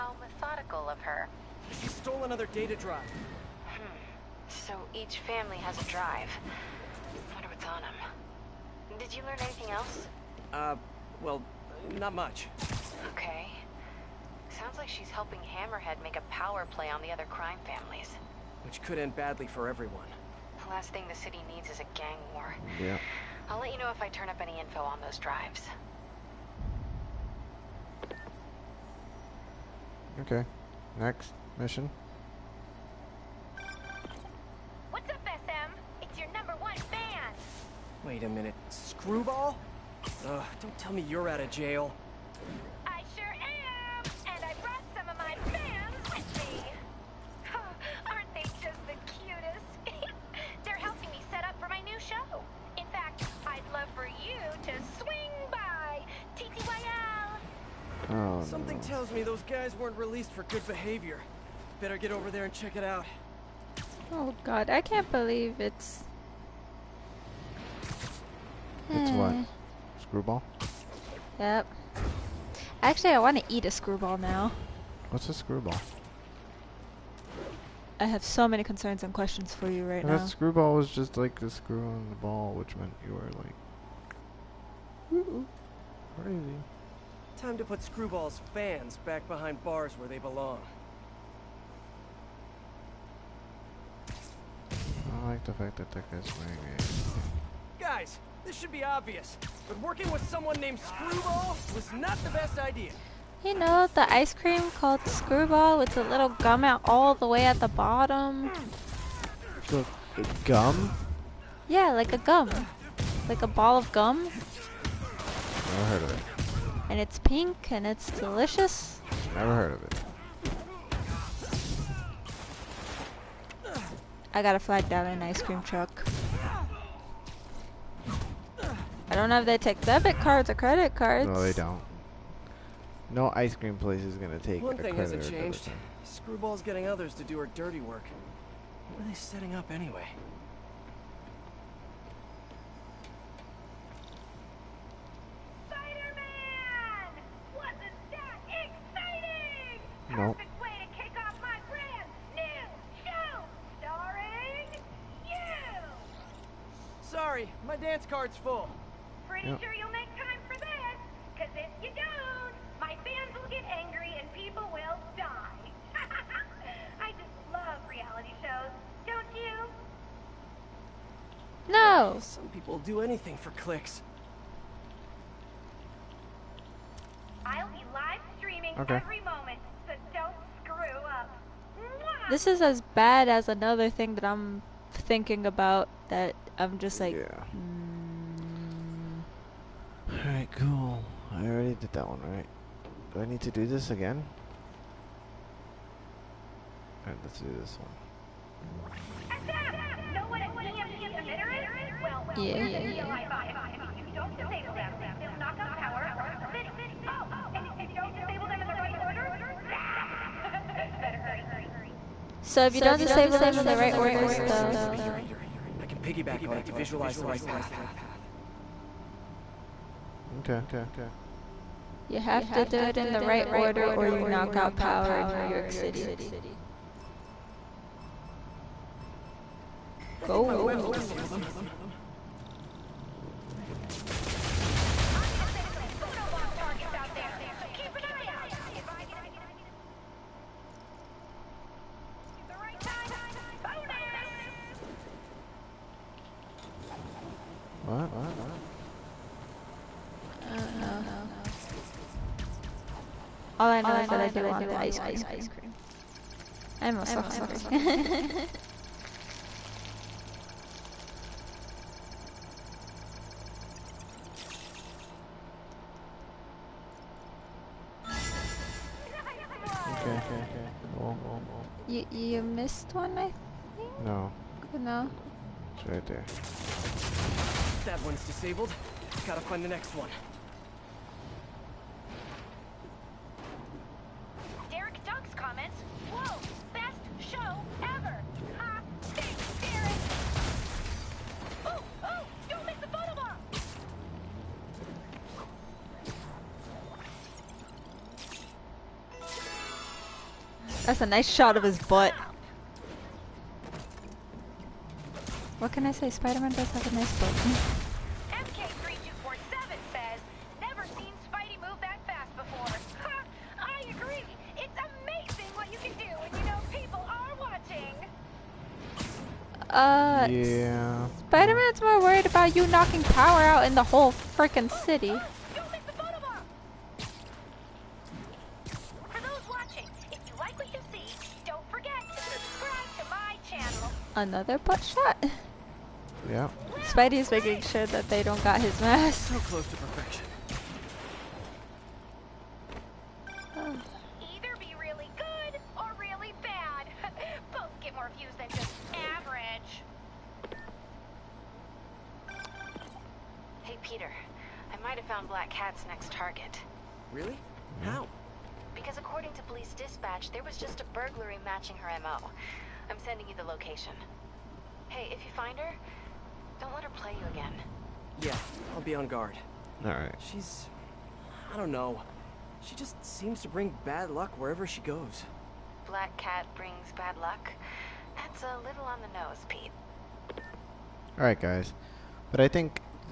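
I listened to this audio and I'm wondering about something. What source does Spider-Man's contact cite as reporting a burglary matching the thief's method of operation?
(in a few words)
police dispatch.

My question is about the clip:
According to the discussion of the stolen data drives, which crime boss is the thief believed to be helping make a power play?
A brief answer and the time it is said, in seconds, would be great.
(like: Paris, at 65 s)
Hammerhead, at 15 s.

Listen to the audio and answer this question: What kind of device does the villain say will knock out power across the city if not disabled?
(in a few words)
EMP emitter.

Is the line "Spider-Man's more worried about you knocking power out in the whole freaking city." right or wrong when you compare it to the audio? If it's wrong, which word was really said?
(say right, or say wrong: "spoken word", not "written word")
right.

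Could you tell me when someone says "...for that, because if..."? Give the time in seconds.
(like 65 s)
160 s.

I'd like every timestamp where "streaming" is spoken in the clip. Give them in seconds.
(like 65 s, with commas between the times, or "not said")
178 s.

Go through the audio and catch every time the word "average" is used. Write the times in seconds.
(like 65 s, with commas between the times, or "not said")
349 s.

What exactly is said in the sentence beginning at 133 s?
No ice cream place is gonna take.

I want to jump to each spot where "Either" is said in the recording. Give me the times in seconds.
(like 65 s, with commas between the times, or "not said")
343 s.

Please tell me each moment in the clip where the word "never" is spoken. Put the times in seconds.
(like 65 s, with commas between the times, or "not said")
114 s, 119 s, 310 s.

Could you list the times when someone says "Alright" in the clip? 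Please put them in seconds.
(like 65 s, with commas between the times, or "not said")
197 s, 369 s, 381 s.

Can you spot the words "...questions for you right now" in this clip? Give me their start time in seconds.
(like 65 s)
79 s.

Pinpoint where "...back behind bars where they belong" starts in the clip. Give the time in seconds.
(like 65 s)
89 s.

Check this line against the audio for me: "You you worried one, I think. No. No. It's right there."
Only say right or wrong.
wrong.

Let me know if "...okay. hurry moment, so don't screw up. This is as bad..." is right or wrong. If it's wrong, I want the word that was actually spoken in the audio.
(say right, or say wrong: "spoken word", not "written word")
wrong: "every", not "hurry".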